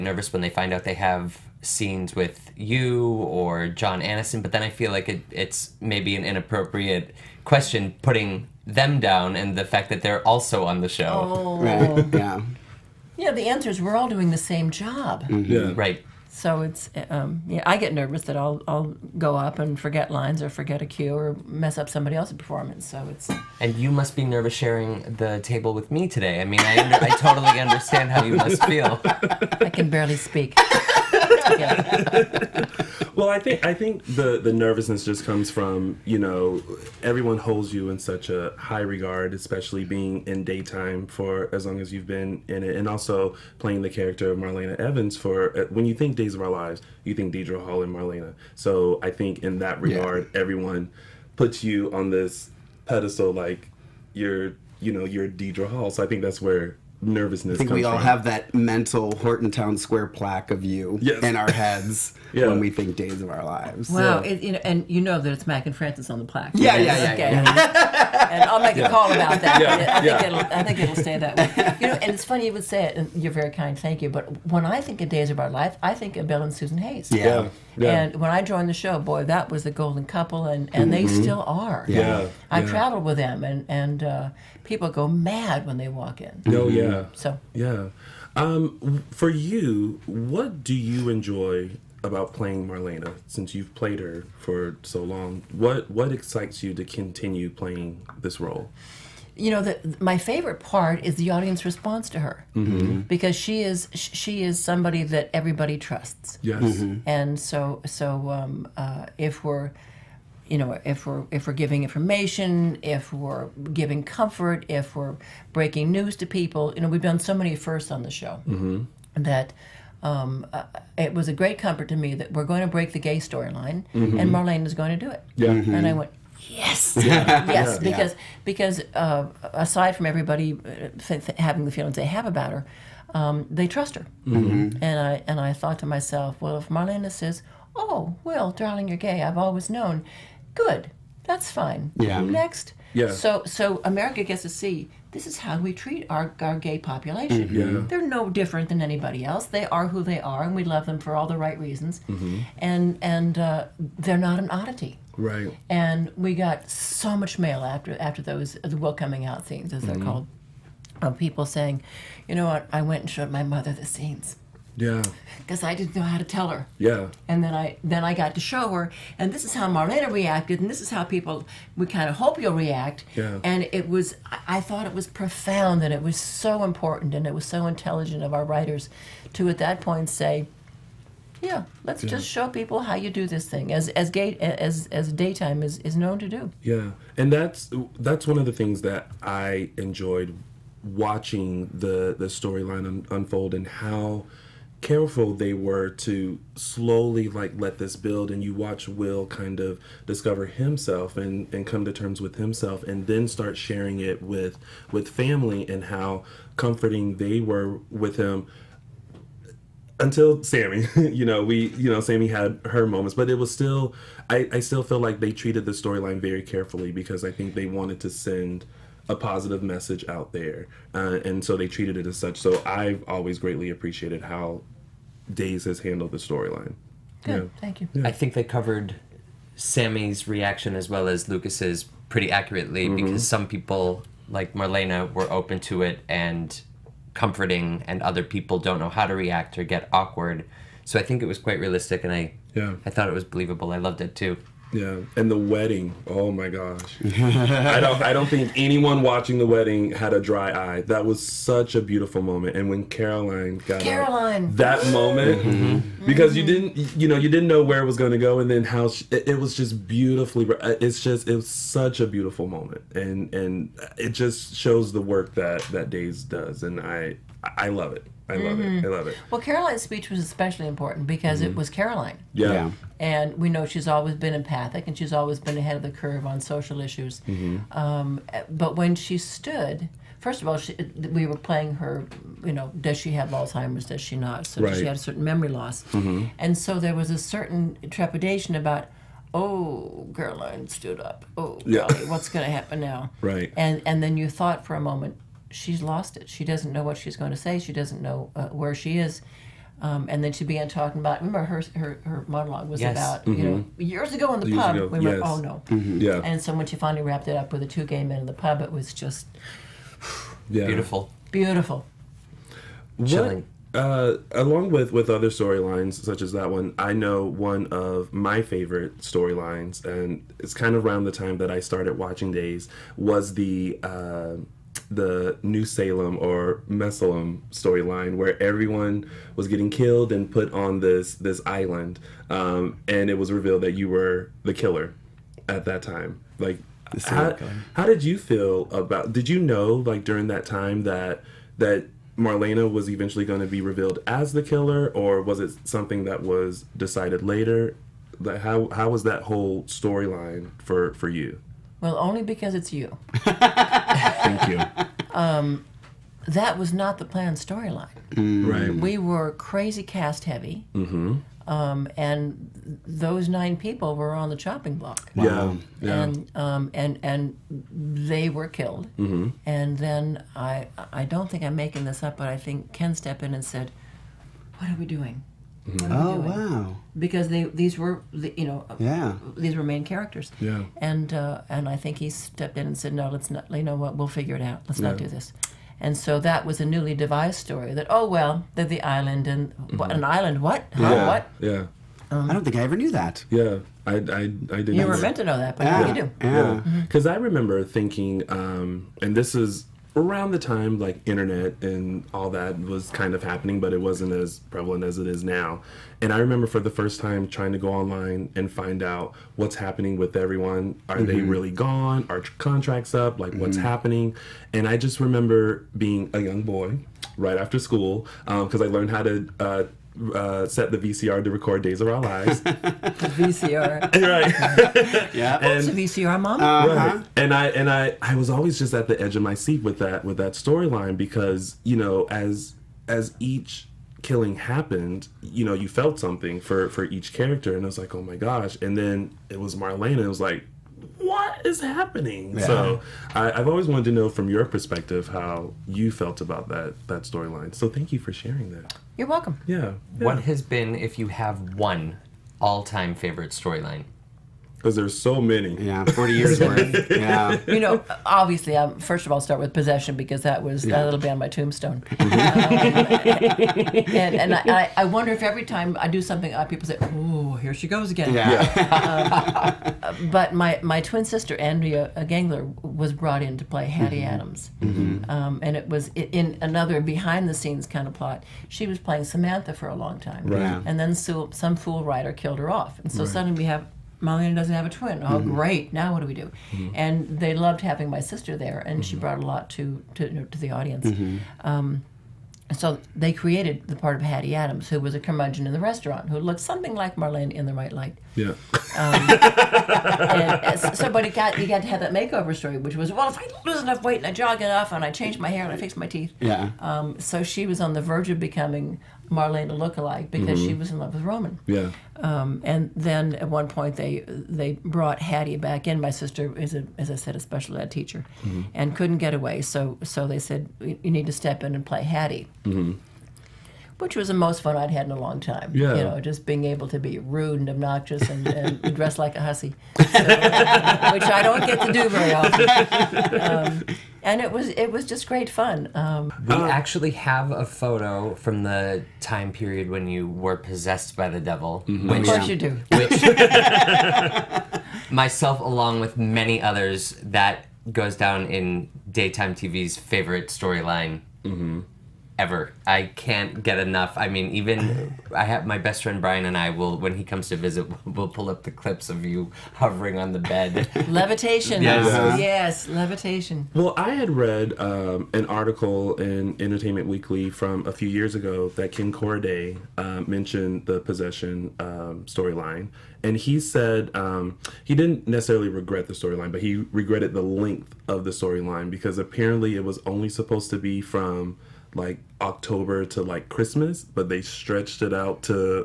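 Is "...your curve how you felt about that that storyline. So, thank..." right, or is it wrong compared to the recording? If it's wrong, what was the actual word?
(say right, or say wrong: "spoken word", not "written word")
wrong: "perspective", not "curve".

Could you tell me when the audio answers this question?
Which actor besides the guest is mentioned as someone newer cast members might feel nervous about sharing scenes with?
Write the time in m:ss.
0:03.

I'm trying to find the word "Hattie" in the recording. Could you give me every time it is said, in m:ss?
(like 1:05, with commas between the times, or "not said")
7:53, 8:14, 8:35, 8:41.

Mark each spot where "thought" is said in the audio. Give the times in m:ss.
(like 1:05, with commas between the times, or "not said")
2:15, 2:54, 4:02, 4:54.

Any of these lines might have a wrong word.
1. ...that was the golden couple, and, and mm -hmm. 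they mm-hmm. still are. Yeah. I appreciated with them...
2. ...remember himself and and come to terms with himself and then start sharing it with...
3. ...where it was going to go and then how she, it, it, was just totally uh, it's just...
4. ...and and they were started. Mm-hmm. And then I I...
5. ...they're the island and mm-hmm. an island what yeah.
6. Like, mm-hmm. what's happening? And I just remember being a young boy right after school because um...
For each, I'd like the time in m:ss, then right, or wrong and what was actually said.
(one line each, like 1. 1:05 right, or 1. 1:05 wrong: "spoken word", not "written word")
1. 1:19 wrong: "traveled", not "appreciated"
2. 3:20 wrong: "discover", not "remember"
3. 4:17 wrong: "beautifully", not "totally"
4. 6:06 wrong: "killed", not "started"
5. 6:28 right
6. 6:53 right.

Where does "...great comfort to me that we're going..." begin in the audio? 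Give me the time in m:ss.
2:01.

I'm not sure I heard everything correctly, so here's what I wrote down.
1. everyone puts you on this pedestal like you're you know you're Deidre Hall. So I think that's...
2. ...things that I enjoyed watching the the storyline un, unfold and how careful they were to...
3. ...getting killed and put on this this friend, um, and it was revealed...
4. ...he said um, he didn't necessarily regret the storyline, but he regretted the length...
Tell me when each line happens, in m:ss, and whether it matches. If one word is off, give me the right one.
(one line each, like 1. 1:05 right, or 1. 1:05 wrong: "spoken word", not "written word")
1. 0:50 right
2. 3:08 right
3. 5:29 wrong: "island", not "friend"
4. 9:33 right.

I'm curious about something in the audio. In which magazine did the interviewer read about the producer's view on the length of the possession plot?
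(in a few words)
Entertainment Weekly.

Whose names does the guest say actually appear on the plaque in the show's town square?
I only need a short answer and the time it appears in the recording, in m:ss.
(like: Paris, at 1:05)
Mac and Frances, at 1:05.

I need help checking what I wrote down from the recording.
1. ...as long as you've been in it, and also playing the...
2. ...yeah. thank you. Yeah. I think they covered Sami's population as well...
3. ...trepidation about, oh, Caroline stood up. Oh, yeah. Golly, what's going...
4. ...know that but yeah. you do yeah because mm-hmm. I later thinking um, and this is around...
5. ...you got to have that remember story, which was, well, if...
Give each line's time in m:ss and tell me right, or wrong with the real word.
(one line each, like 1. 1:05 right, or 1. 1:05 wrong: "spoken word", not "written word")
1. 0:41 right
2. 3:47 wrong: "reaction", not "population"
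3. 4:47 right
4. 6:35 wrong: "remember", not "later"
5. 8:21 wrong: "makeover", not "remember".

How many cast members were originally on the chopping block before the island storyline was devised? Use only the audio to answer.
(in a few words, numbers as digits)
9.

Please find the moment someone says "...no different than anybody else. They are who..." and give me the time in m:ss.
2:28.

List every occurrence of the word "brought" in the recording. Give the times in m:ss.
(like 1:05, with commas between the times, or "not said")
7:52, 8:08, 8:34.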